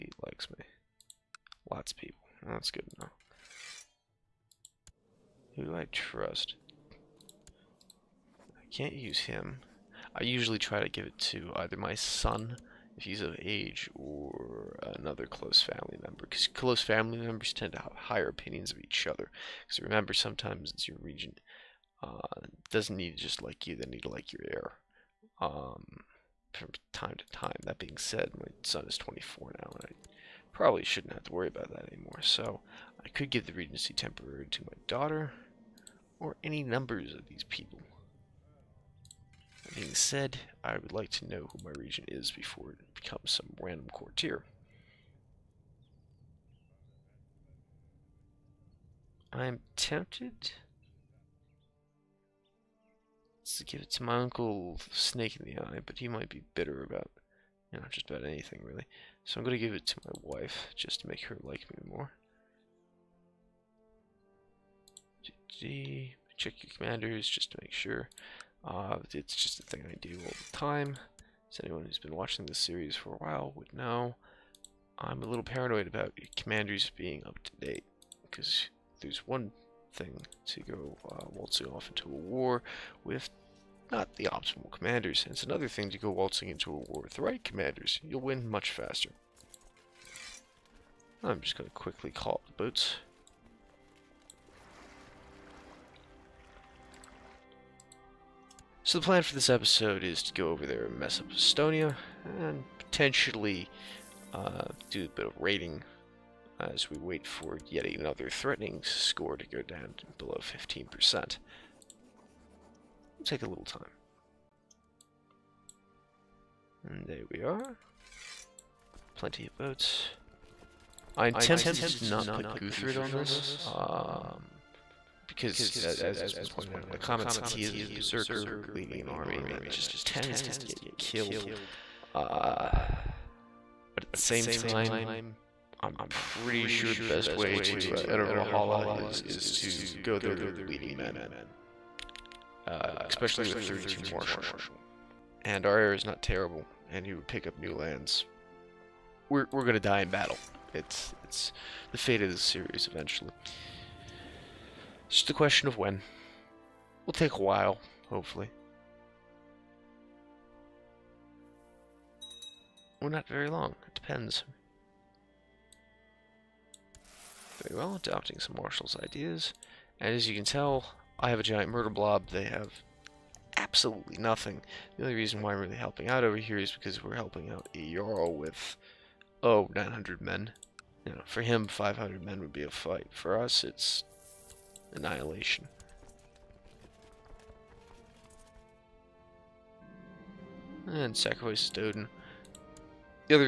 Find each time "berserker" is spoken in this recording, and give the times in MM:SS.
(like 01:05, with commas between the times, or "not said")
02:07.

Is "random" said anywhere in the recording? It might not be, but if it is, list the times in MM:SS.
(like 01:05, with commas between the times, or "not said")
00:43.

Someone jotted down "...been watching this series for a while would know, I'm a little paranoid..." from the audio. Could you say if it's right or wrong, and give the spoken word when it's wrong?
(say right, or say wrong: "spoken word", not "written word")
right.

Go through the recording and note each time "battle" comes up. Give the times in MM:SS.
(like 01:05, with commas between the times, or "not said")
02:30.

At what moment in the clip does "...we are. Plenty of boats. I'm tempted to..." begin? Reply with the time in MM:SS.
01:57.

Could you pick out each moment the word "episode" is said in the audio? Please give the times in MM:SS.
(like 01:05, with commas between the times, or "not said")
01:39.